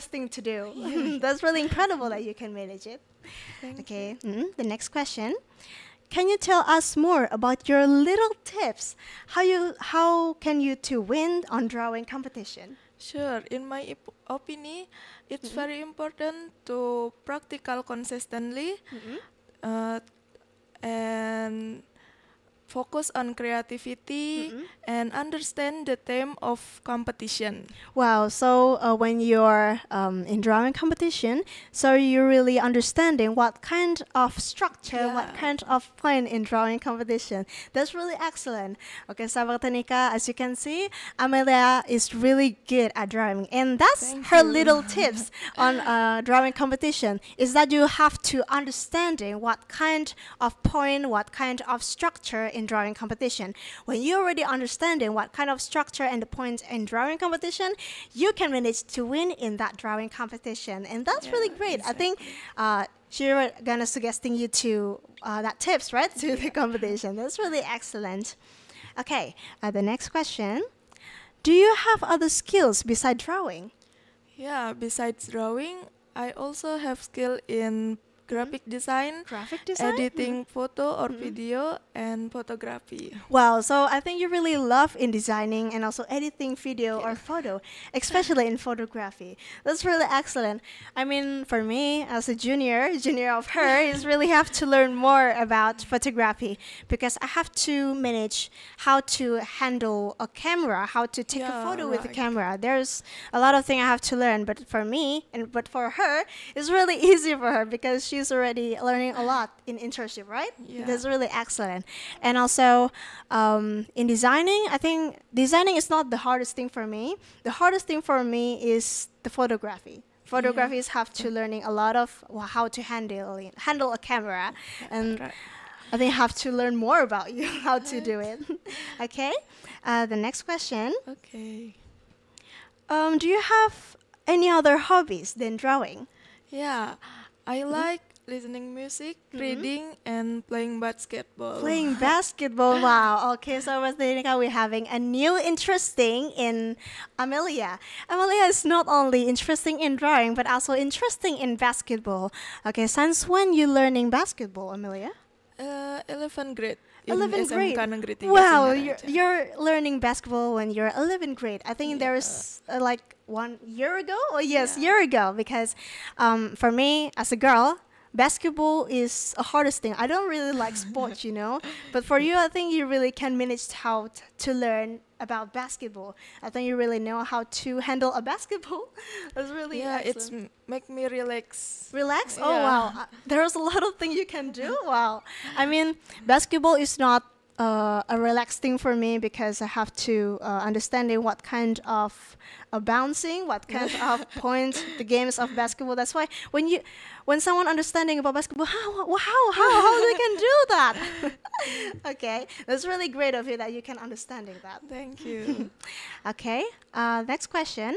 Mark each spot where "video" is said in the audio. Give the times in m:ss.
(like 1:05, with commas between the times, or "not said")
1:21, 1:26.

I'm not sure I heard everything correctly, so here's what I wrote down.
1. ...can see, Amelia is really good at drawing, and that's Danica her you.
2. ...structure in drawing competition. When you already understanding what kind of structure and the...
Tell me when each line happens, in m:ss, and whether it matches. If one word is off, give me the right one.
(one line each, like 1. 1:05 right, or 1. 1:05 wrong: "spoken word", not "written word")
1. 0:40 wrong: "Thank", not "Danica"
2. 0:51 right.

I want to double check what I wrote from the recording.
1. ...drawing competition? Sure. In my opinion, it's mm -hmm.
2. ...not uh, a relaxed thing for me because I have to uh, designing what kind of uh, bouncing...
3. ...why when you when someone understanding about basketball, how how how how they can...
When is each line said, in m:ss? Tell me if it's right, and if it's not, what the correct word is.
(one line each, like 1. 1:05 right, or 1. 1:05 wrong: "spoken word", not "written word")
1. 0:11 right
2. 3:06 wrong: "understanding", not "designing"
3. 3:16 right.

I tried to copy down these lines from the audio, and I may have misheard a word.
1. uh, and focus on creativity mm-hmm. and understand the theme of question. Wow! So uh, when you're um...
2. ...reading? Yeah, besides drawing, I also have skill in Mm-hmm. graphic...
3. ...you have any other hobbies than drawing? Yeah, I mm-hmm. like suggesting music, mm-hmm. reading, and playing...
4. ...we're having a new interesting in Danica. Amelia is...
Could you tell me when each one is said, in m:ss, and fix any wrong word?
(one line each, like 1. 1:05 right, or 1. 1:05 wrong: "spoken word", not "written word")
1. 0:19 wrong: "competition", not "question"
2. 1:13 wrong: "drawing", not "reading"
3. 2:13 wrong: "listening", not "suggesting"
4. 2:24 wrong: "Amelia", not "Danica".